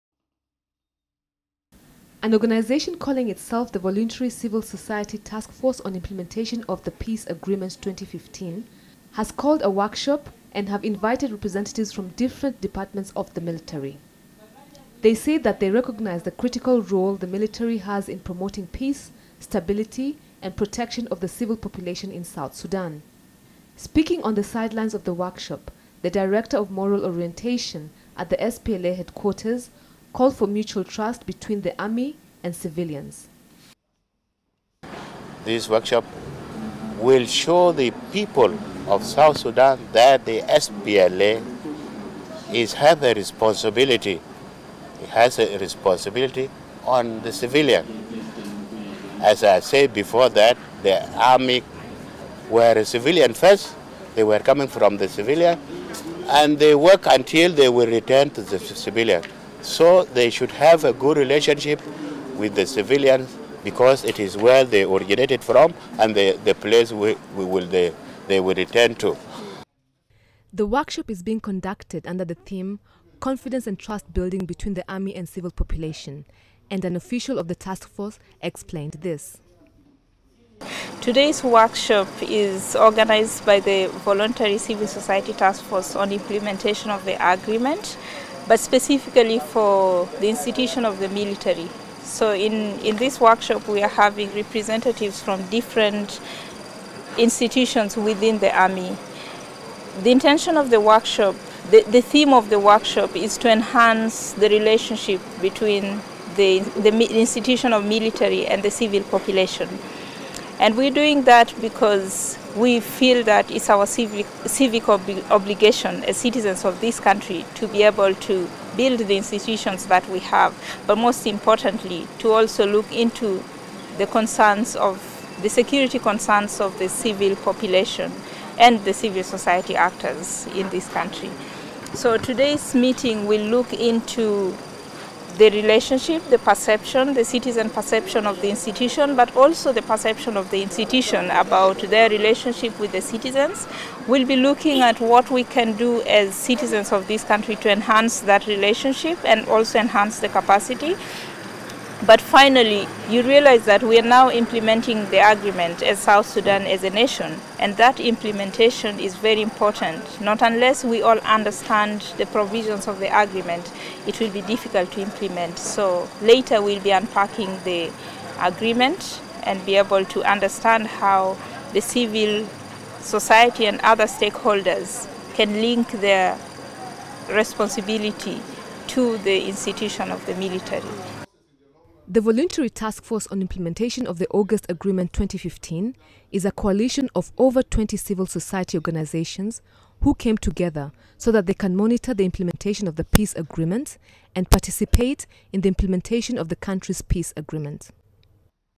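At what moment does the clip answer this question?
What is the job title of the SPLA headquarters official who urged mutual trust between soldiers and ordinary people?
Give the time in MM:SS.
00:26.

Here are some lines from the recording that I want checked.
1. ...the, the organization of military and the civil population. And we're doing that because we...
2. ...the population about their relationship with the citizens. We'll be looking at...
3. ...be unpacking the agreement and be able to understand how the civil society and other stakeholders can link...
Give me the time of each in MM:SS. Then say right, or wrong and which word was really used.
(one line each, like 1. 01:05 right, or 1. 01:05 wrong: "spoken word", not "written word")
1. 01:46 wrong: "institution", not "organization"
2. 02:20 wrong: "institution", not "population"
3. 02:46 right.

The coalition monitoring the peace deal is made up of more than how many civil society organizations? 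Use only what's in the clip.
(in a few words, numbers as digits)
20.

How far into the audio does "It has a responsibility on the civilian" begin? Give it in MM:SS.
00:45.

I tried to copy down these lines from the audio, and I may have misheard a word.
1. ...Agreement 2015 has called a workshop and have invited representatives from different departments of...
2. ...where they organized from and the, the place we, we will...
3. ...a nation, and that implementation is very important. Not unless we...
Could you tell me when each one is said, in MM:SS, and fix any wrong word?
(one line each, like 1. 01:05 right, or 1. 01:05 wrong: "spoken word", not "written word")
1. 00:07 right
2. 01:04 wrong: "originated", not "organized"
3. 02:36 right.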